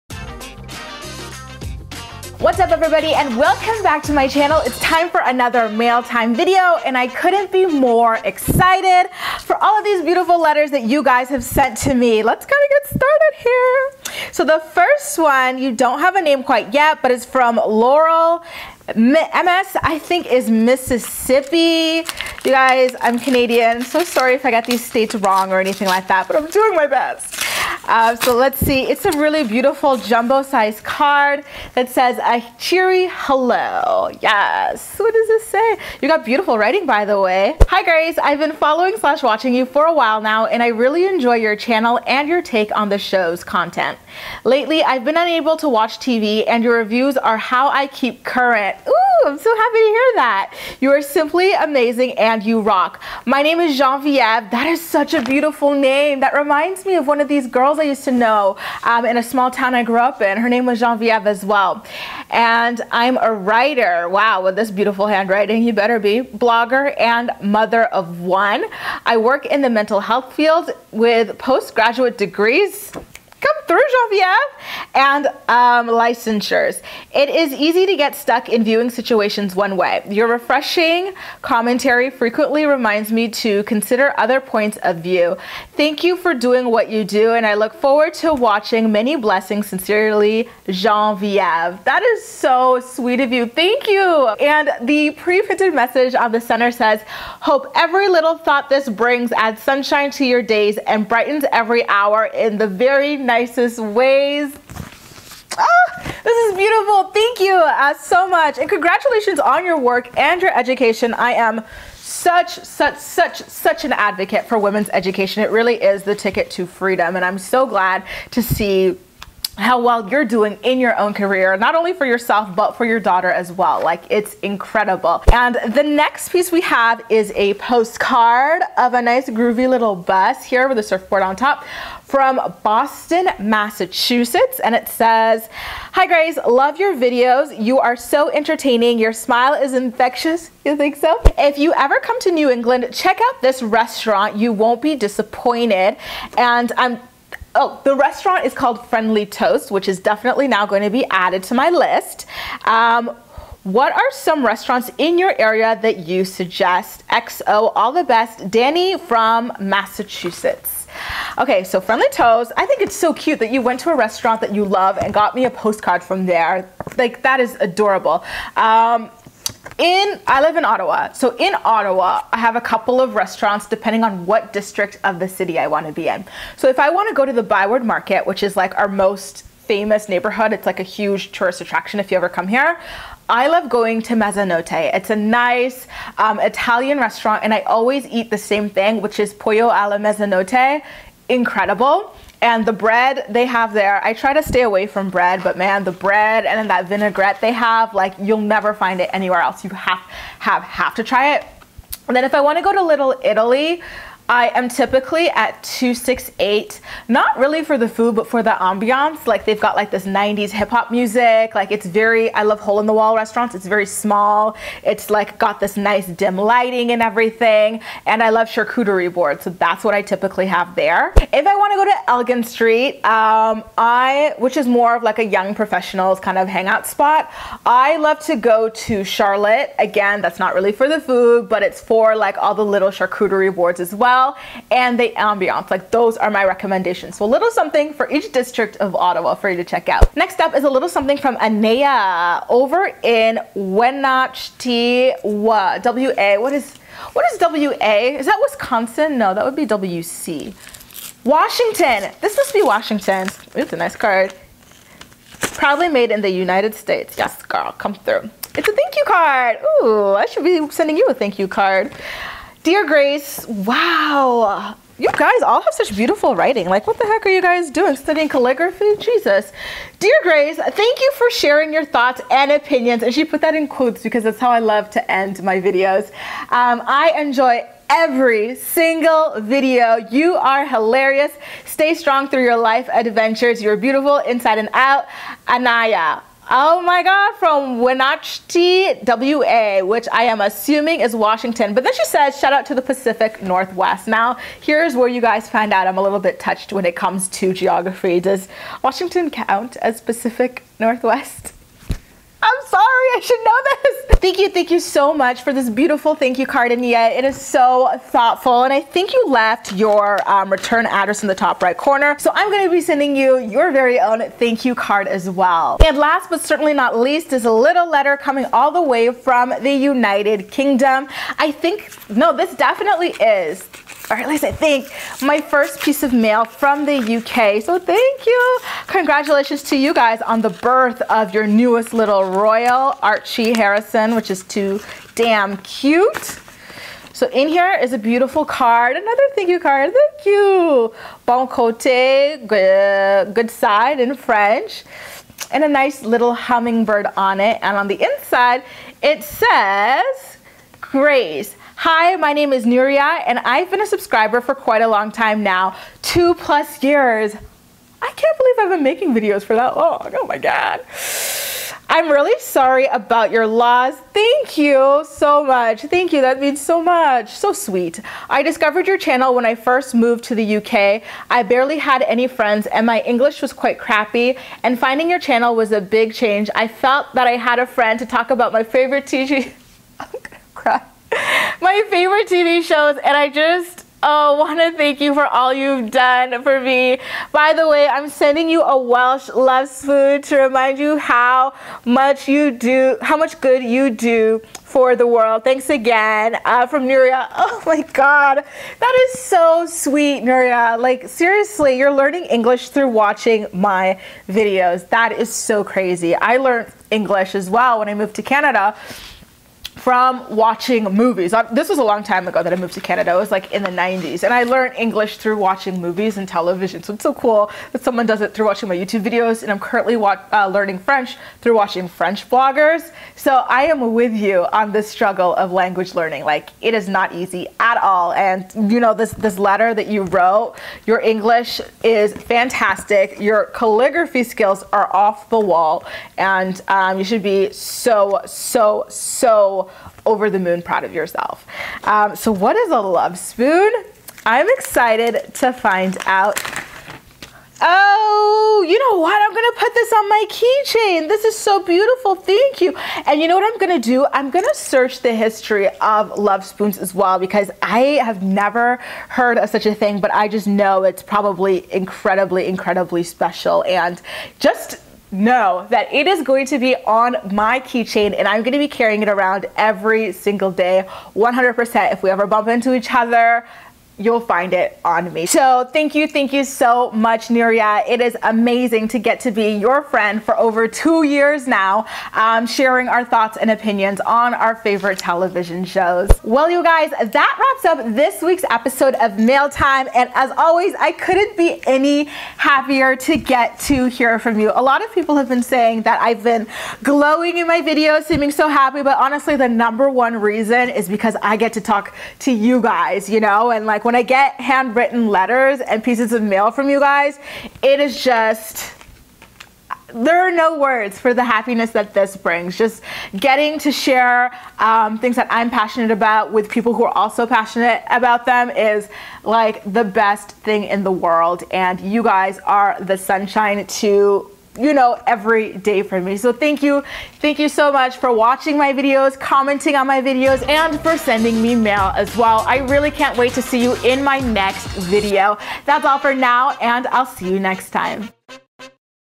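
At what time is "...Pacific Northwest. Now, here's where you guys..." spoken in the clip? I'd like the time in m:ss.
4:52.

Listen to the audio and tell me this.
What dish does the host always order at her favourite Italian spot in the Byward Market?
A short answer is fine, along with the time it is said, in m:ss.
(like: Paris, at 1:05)
pollo alla mezzanotte, at 3:09.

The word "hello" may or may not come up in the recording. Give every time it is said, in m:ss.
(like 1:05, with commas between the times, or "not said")
0:33.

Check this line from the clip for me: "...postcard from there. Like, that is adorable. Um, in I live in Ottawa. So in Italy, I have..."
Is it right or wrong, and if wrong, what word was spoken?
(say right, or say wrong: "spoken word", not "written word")
wrong: "Ottawa", not "Italy".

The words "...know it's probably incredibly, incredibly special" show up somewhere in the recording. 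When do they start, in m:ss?
7:40.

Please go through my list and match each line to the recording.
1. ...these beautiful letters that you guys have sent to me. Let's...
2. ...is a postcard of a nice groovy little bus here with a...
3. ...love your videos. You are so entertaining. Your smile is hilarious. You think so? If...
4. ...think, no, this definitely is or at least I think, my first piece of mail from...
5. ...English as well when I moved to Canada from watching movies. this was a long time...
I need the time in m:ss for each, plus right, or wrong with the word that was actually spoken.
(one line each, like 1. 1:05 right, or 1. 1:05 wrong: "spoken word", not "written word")
1. 0:09 right
2. 2:07 right
3. 2:16 wrong: "infectious", not "hilarious"
4. 5:21 right
5. 6:46 right.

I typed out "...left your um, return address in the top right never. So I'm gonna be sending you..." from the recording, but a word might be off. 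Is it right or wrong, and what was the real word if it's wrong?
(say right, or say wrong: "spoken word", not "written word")
wrong: "corner", not "never".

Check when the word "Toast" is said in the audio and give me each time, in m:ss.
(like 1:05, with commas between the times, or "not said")
2:29, 2:42.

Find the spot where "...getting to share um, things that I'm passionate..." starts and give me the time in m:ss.
8:33.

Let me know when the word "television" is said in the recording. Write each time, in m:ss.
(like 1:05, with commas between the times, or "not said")
6:56, 8:04.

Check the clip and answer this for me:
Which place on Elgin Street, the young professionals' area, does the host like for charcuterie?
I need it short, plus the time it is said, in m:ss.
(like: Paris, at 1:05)
Charlotte, at 3:49.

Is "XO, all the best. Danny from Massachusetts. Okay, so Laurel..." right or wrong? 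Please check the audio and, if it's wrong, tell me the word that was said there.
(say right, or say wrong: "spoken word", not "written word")
wrong: "Friendly", not "Laurel".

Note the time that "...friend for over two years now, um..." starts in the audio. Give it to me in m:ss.
7:59.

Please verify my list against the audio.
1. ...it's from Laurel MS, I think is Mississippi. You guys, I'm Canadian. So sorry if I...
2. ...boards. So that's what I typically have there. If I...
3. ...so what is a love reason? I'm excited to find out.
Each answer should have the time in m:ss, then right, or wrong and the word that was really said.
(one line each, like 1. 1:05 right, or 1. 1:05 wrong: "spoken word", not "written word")
1. 0:17 right
2. 3:39 right
3. 7:22 wrong: "spoon", not "reason".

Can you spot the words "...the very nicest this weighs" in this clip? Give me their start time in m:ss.
1:42.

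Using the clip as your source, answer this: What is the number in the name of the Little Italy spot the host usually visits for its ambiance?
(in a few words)
268.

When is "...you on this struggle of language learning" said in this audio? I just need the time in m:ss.
7:04.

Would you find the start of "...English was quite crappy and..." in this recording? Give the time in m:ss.
6:13.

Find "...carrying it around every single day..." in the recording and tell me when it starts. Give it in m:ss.
7:48.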